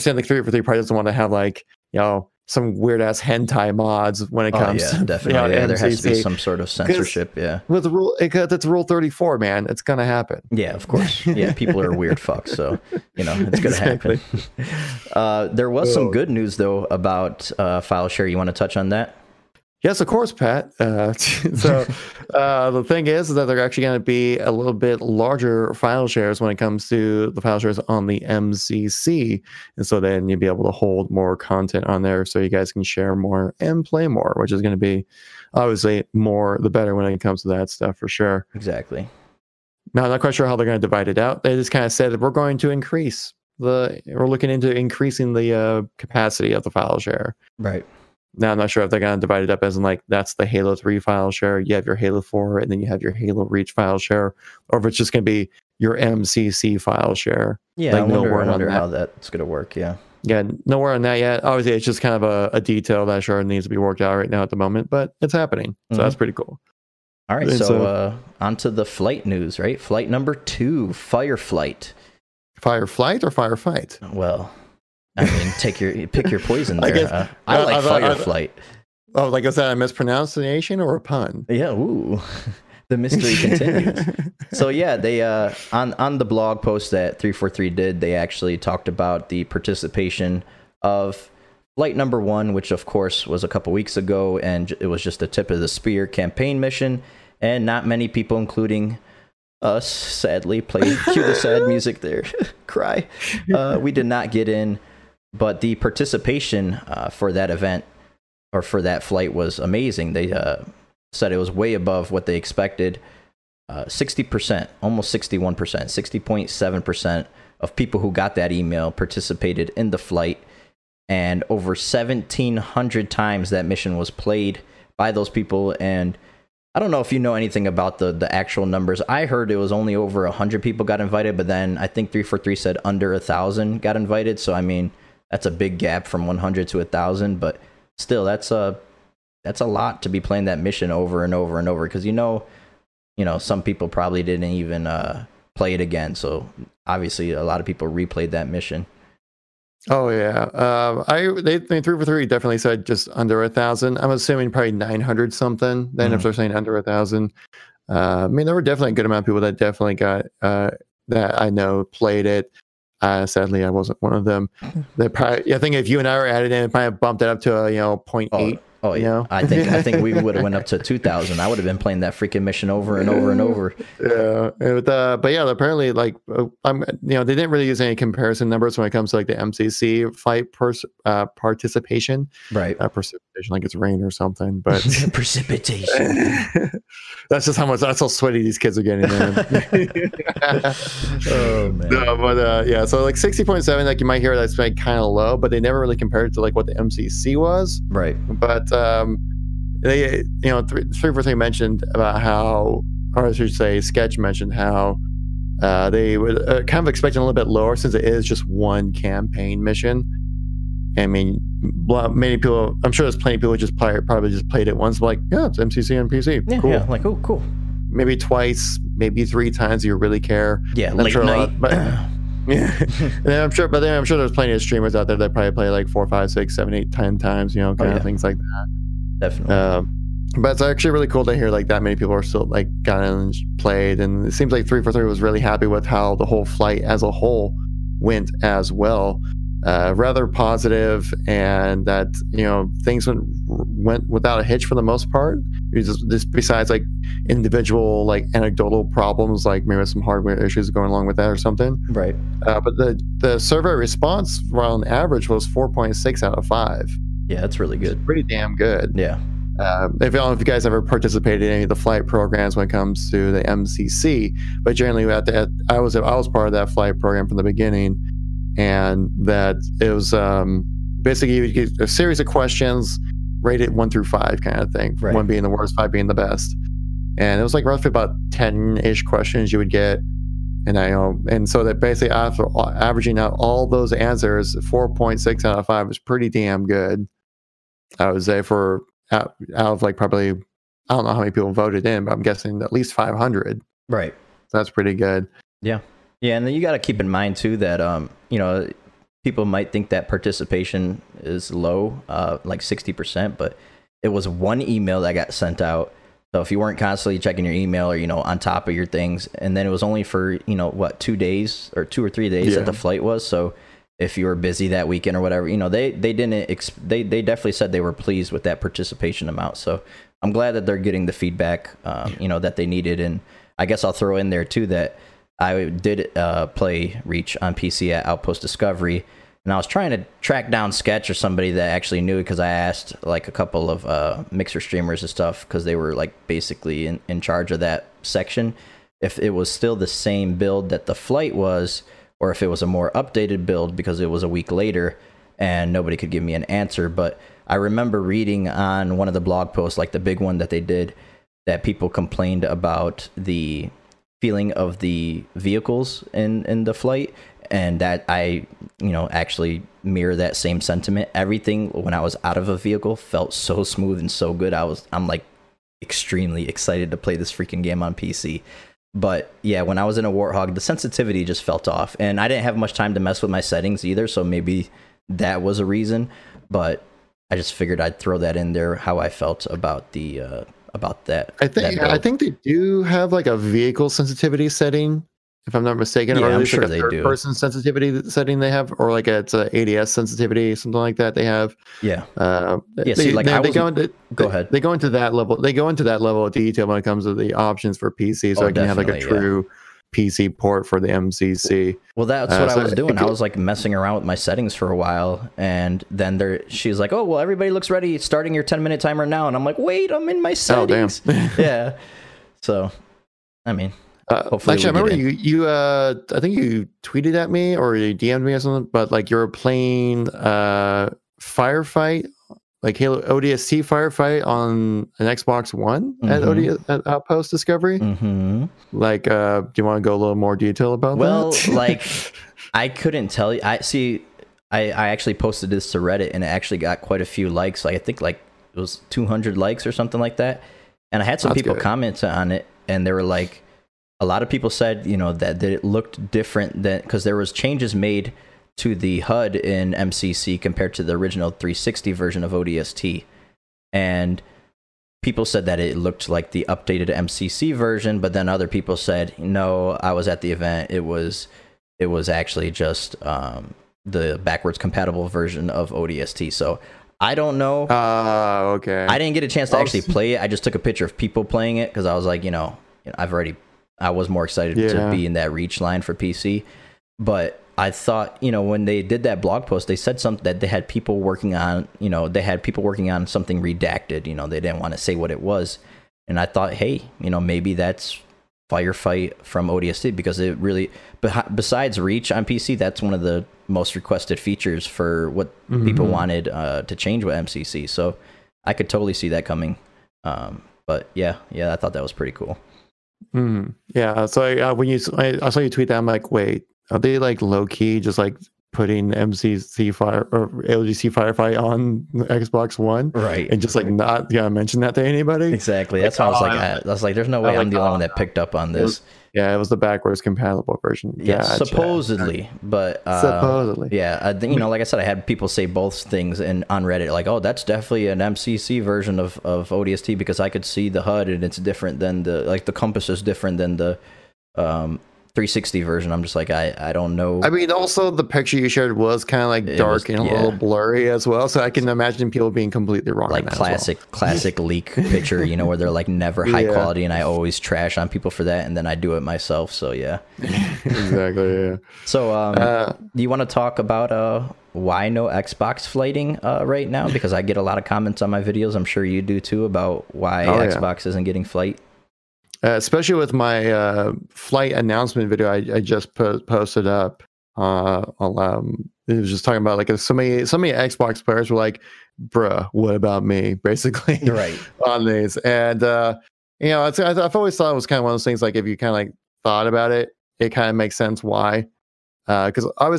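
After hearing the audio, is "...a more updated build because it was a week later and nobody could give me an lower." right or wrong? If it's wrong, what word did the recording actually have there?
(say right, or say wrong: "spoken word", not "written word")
wrong: "answer", not "lower".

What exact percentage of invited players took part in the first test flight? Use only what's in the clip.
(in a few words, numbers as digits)
60.7%.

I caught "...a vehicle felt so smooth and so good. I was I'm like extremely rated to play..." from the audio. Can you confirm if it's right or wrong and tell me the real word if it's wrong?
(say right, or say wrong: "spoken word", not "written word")
wrong: "excited", not "rated".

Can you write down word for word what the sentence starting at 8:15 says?
people wanted uh, to change with MCC.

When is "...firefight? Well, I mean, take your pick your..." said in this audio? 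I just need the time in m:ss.
1:13.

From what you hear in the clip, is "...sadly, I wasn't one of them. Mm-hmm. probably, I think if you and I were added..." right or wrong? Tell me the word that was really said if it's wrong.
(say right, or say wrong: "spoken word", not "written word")
right.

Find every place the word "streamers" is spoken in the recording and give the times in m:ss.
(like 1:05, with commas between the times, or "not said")
3:44, 5:34.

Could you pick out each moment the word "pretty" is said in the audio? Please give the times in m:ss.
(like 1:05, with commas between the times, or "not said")
1:06, 4:18, 4:45, 4:54, 8:21.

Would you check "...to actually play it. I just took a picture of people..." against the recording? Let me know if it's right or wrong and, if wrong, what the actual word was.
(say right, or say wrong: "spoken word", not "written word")
right.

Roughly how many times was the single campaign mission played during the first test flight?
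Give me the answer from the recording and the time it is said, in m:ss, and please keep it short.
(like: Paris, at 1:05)
Over 1,700, at 2:01.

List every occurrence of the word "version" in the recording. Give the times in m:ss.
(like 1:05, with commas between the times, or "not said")
7:31, 7:37, 7:45, 8:40, 8:48, 8:55.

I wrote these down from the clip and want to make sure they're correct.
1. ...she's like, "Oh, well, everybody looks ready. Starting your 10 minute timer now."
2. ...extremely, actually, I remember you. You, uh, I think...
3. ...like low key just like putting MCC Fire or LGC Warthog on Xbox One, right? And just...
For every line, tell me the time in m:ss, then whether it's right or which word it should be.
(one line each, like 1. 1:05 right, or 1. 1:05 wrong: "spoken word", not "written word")
1. 6:46 right
2. 6:54 wrong: "hopefully", not "extremely"
3. 8:26 wrong: "Firefight", not "Warthog".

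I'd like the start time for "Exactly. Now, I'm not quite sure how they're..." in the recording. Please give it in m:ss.
0:38.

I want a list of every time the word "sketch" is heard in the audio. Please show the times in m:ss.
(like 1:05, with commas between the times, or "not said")
3:23, 5:30.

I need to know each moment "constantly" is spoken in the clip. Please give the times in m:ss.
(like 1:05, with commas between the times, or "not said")
5:06.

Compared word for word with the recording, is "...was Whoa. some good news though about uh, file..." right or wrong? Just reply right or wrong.
right.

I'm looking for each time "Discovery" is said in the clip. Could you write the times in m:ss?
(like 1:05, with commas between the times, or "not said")
5:28, 7:07.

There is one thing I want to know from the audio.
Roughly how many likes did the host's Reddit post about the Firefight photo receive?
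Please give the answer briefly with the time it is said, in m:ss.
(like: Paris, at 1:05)
200, at 7:18.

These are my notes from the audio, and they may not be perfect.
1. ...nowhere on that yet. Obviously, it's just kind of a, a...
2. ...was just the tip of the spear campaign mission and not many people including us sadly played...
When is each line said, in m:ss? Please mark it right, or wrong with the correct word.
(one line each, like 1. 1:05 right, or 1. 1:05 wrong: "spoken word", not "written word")
1. 1:00 right
2. 1:34 right.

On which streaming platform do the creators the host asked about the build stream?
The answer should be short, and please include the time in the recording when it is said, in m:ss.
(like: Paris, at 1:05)
Mixer, at 5:34.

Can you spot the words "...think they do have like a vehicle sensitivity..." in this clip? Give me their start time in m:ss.
6:21.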